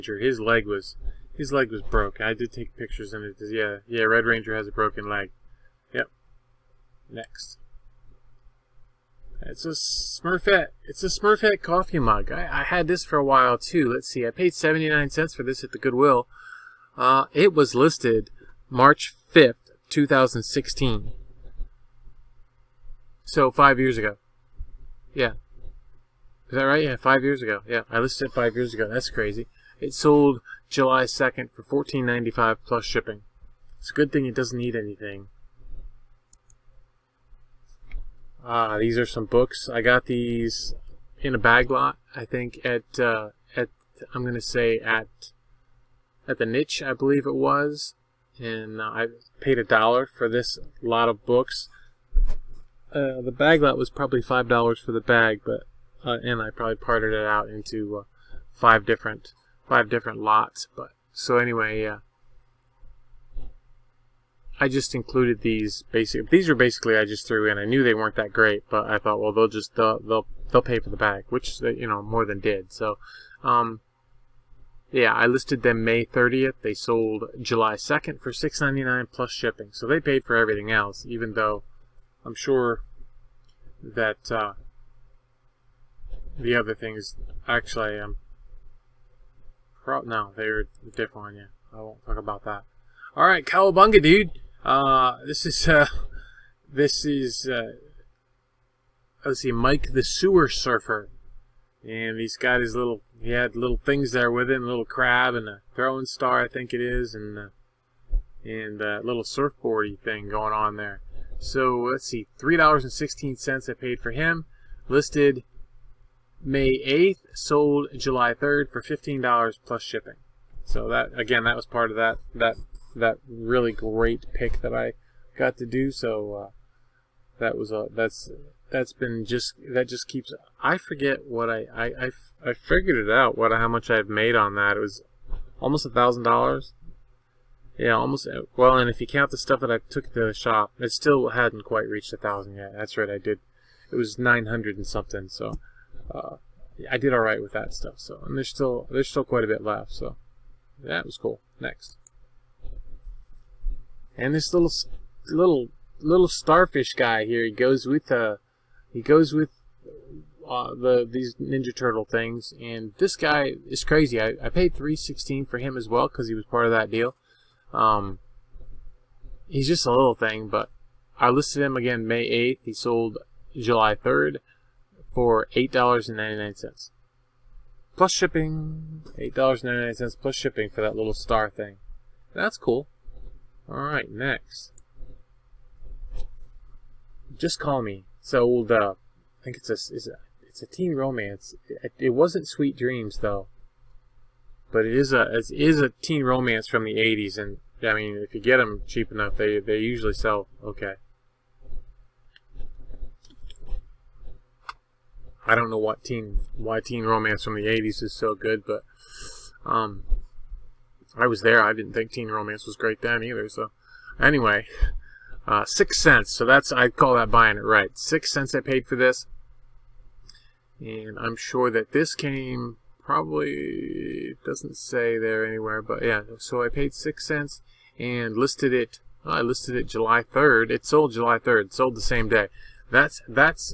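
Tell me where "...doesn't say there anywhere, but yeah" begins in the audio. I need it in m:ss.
3:44.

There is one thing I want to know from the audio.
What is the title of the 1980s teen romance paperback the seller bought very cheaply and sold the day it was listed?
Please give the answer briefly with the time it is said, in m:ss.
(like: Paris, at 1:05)
Just Call Me, at 3:07.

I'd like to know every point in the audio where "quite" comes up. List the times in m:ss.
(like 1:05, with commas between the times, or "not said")
2:21, 2:29.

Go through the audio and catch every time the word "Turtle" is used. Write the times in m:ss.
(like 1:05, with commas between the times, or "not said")
2:41.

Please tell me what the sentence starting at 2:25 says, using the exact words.
So uh, I did all right with that stuff.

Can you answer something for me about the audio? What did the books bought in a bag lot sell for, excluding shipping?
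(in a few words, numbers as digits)
$6.99.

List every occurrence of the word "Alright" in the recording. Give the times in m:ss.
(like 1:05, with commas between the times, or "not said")
1:33, 3:03.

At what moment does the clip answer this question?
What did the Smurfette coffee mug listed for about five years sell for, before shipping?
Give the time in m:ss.
0:31.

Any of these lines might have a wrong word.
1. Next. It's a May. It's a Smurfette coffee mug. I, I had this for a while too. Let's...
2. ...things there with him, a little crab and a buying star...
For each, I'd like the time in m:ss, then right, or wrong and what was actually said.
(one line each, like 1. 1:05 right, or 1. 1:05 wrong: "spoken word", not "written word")
1. 0:07 wrong: "Smurfette", not "May"
2. 1:43 wrong: "throwing", not "buying".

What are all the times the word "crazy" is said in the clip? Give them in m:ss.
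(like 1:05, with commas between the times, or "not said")
0:29, 2:43.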